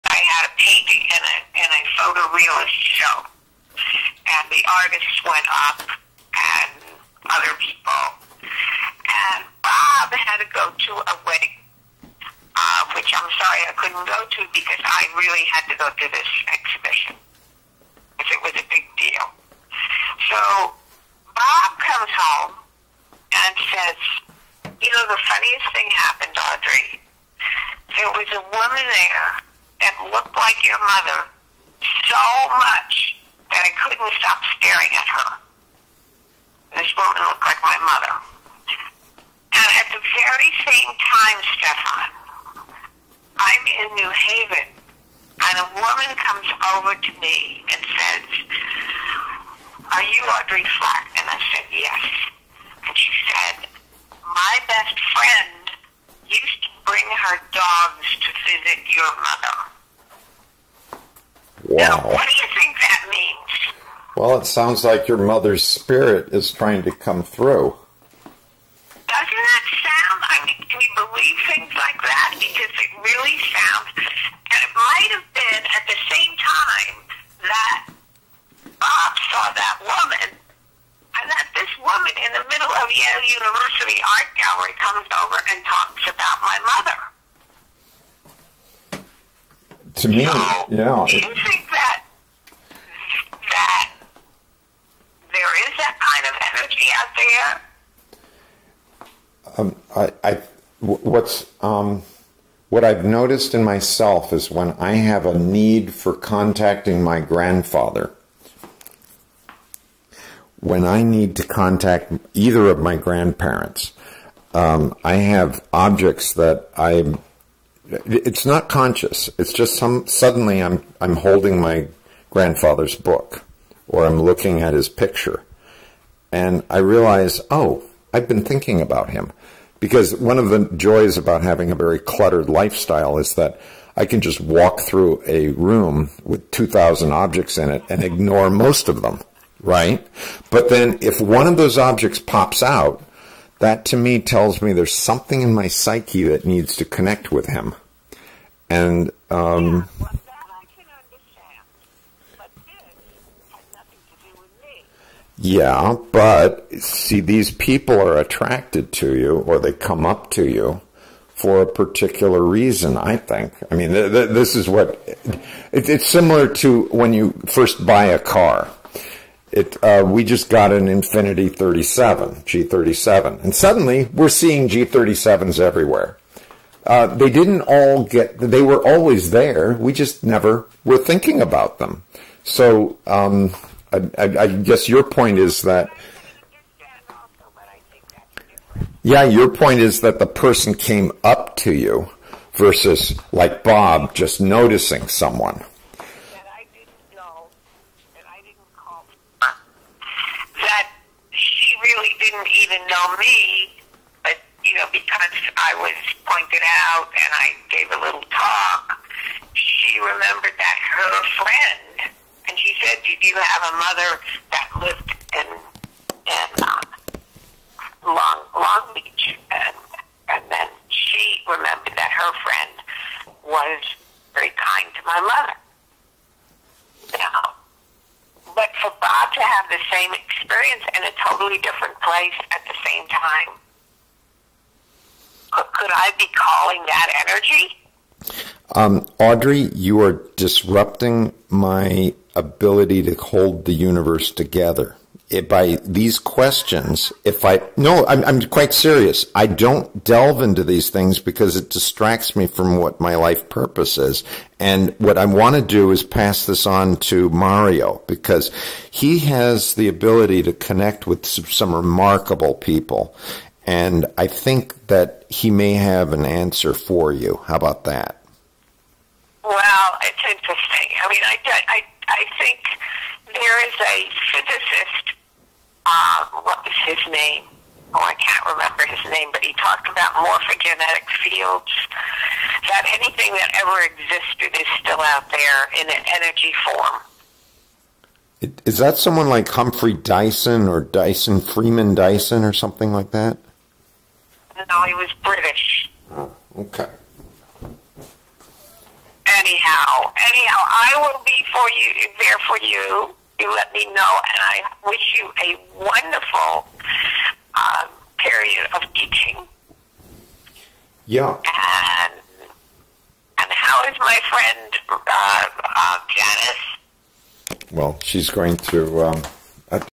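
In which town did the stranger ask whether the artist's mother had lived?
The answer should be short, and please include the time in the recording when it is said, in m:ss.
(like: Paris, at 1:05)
Long Beach, at 3:38.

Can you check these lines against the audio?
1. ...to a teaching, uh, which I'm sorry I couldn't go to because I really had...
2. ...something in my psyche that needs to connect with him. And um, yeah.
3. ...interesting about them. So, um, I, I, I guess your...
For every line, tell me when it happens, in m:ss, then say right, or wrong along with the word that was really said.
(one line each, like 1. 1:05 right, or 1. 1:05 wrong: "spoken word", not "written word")
1. 0:10 wrong: "wedding", not "teaching"
2. 2:24 right
3. 3:01 wrong: "thinking", not "interesting".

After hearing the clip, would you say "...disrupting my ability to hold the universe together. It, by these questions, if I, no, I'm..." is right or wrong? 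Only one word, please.
right.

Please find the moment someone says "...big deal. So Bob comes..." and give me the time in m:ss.
0:18.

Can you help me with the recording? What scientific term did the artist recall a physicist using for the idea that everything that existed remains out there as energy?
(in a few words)
morphogenetic fields.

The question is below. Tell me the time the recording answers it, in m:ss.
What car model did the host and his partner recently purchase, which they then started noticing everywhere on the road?
2:52.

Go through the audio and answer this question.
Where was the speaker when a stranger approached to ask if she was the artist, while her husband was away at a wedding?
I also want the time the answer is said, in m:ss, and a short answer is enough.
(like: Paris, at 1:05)
New Haven, at 0:43.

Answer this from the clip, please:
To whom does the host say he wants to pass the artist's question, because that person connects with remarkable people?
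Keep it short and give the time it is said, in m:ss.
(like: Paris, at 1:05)
Mario, at 4:17.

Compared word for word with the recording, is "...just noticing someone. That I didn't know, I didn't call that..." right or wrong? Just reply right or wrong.
right.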